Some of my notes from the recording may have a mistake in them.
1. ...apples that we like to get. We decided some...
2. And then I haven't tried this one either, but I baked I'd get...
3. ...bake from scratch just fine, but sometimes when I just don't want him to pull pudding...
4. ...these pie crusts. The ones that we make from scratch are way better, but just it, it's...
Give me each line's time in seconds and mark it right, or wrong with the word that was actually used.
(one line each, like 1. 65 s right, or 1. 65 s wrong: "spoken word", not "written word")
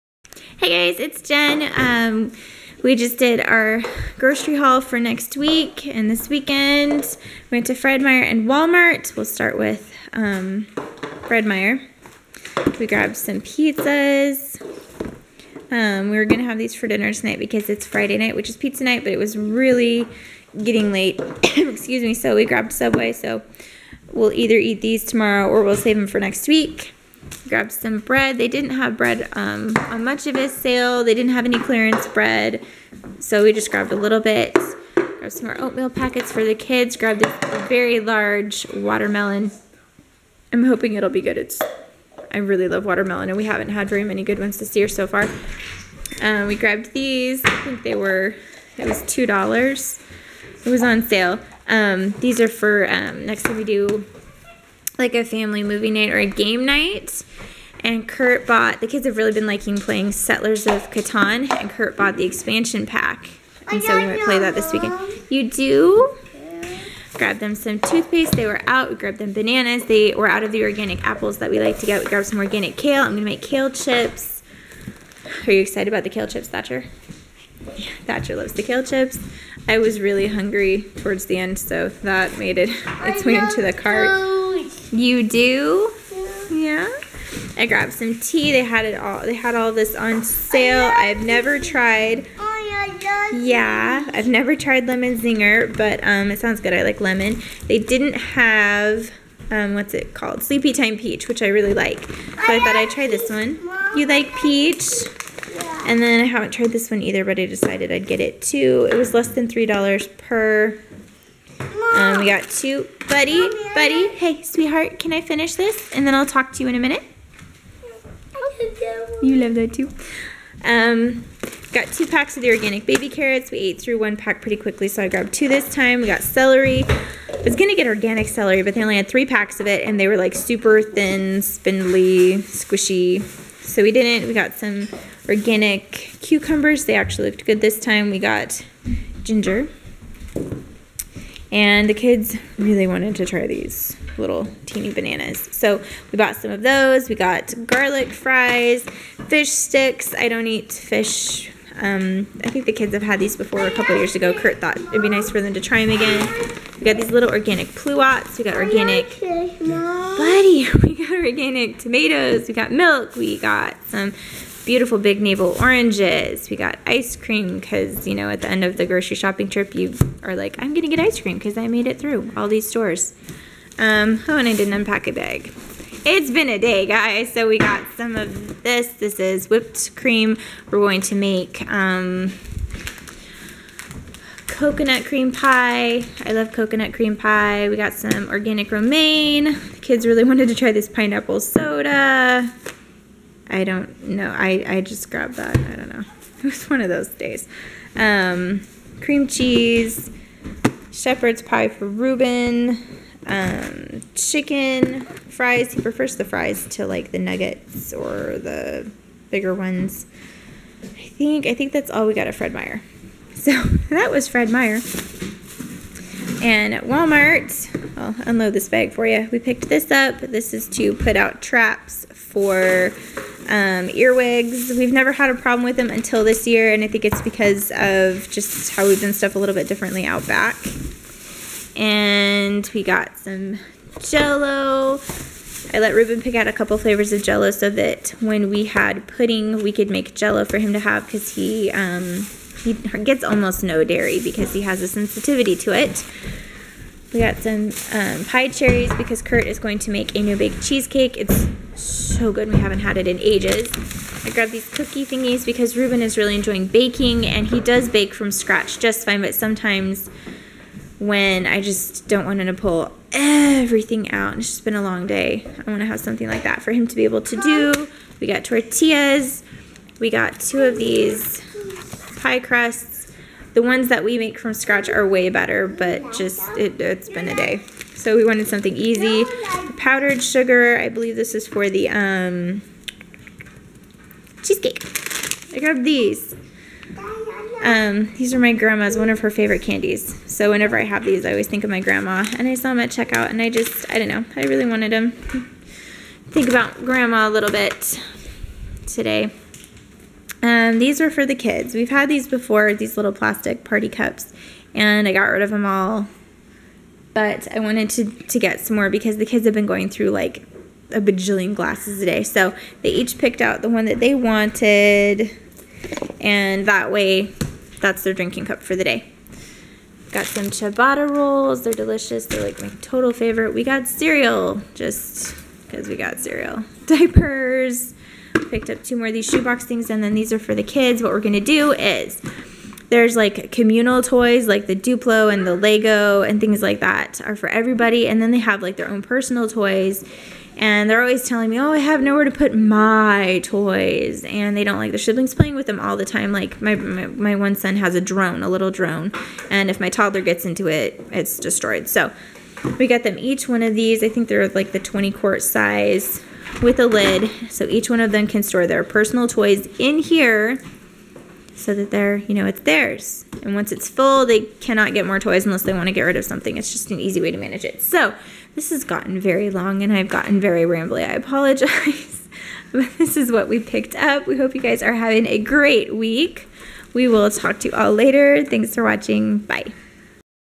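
1. 71 s wrong: "grabbed", not "decided"
2. 105 s wrong: "decided", not "baked"
3. 257 s wrong: "everything", not "pudding"
4. 270 s right.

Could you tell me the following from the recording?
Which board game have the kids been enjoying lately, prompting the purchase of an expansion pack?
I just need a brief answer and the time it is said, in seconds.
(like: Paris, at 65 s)
Settlers of Catan, at 60 s.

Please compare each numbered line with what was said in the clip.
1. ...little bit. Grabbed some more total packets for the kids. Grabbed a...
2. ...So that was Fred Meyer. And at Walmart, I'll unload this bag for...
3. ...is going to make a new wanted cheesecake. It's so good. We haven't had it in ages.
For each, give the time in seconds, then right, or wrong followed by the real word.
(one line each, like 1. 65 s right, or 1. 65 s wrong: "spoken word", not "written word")
1. 33 s wrong: "oatmeal", not "total"
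2. 213 s right
3. 249 s wrong: "baked", not "wanted".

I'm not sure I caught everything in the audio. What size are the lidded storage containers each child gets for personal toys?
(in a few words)
20 quart.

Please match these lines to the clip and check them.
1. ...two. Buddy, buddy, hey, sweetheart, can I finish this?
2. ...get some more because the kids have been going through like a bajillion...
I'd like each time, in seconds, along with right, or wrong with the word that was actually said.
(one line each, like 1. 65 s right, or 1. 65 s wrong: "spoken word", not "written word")
1. 112 s right
2. 308 s right.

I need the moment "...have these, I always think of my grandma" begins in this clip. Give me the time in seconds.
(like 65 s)
290 s.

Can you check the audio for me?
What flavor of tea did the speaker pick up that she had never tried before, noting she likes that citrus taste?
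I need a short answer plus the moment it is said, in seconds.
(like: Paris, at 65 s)
Lemon Zinger, at 94 s.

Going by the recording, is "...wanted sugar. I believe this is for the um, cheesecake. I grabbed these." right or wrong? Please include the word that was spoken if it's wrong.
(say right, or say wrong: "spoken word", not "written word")
wrong: "powdered", not "wanted".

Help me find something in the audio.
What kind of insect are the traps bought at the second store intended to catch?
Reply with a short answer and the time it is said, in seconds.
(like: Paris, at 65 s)
Earwigs, at 223 s.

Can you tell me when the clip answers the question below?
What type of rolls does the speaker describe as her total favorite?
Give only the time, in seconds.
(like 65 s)
320 s.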